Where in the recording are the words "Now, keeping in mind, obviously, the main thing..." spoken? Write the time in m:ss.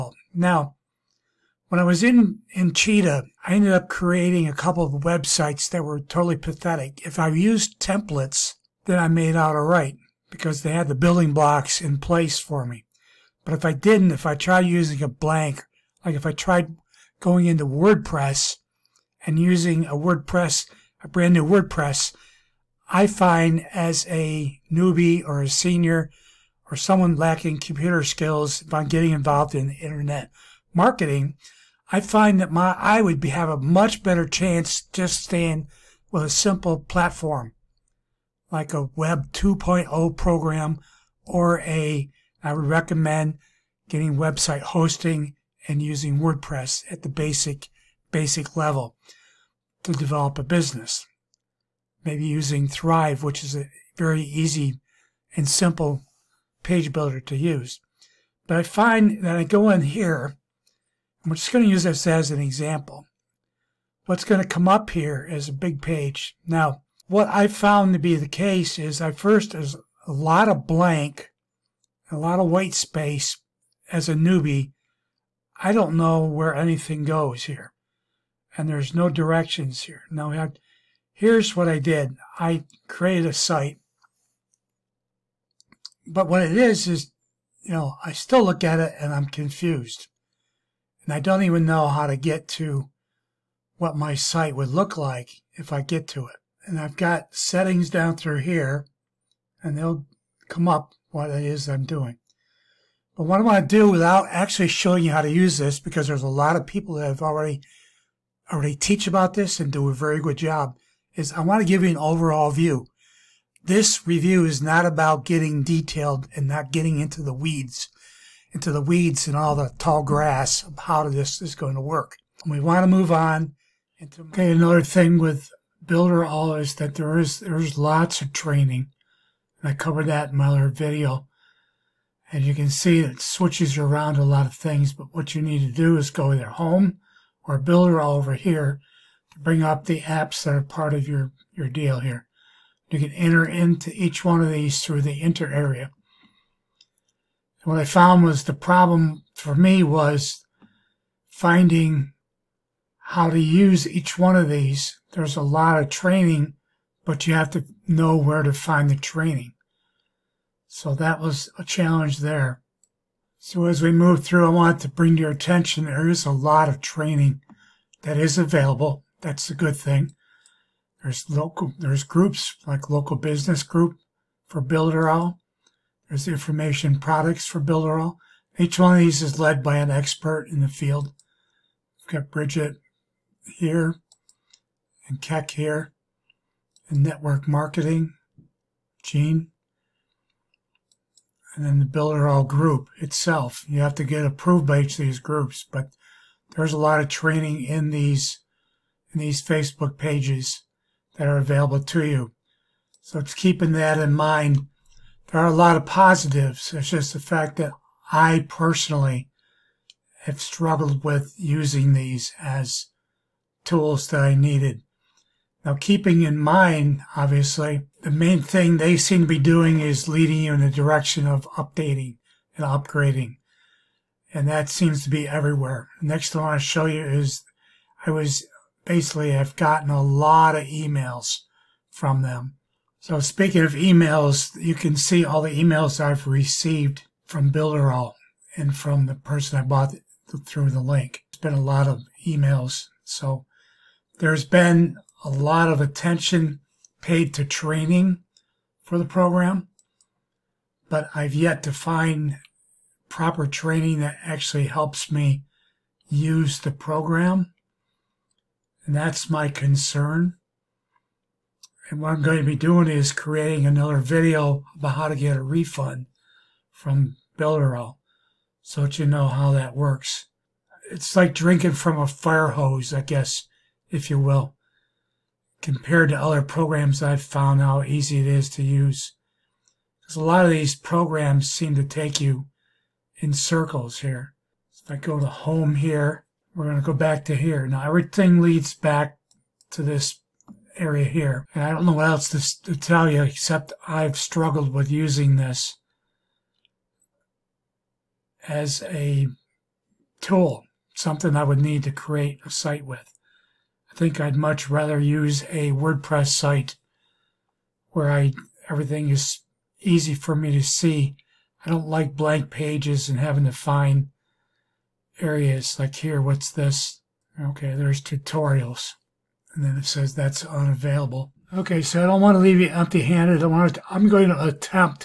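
3:35.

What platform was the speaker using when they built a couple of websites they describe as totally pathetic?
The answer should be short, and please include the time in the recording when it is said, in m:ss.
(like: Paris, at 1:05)
Cheetah, at 0:02.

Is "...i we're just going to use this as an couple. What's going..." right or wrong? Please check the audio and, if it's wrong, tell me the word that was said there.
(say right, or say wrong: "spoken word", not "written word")
wrong: "example", not "couple".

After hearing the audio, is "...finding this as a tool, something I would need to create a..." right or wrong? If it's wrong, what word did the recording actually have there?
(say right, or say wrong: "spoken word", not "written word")
wrong: "using", not "finding".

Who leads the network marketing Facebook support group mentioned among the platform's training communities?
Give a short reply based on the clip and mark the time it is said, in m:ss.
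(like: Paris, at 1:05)
Gene, at 3:09.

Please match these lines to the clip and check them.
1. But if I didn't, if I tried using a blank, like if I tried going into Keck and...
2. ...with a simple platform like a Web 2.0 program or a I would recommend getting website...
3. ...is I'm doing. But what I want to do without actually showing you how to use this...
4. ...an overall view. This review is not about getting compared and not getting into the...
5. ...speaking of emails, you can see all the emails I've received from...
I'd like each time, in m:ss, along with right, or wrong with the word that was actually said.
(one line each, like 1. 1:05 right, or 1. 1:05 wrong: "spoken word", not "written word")
1. 0:13 wrong: "WordPress", not "Keck"
2. 0:36 right
3. 1:41 right
4. 1:51 wrong: "detailed", not "compared"
5. 3:53 right.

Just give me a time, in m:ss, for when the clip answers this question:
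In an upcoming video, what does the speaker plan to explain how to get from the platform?
4:25.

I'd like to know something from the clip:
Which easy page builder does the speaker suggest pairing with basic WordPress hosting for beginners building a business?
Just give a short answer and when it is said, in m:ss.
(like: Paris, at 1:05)
Thrive, at 0:52.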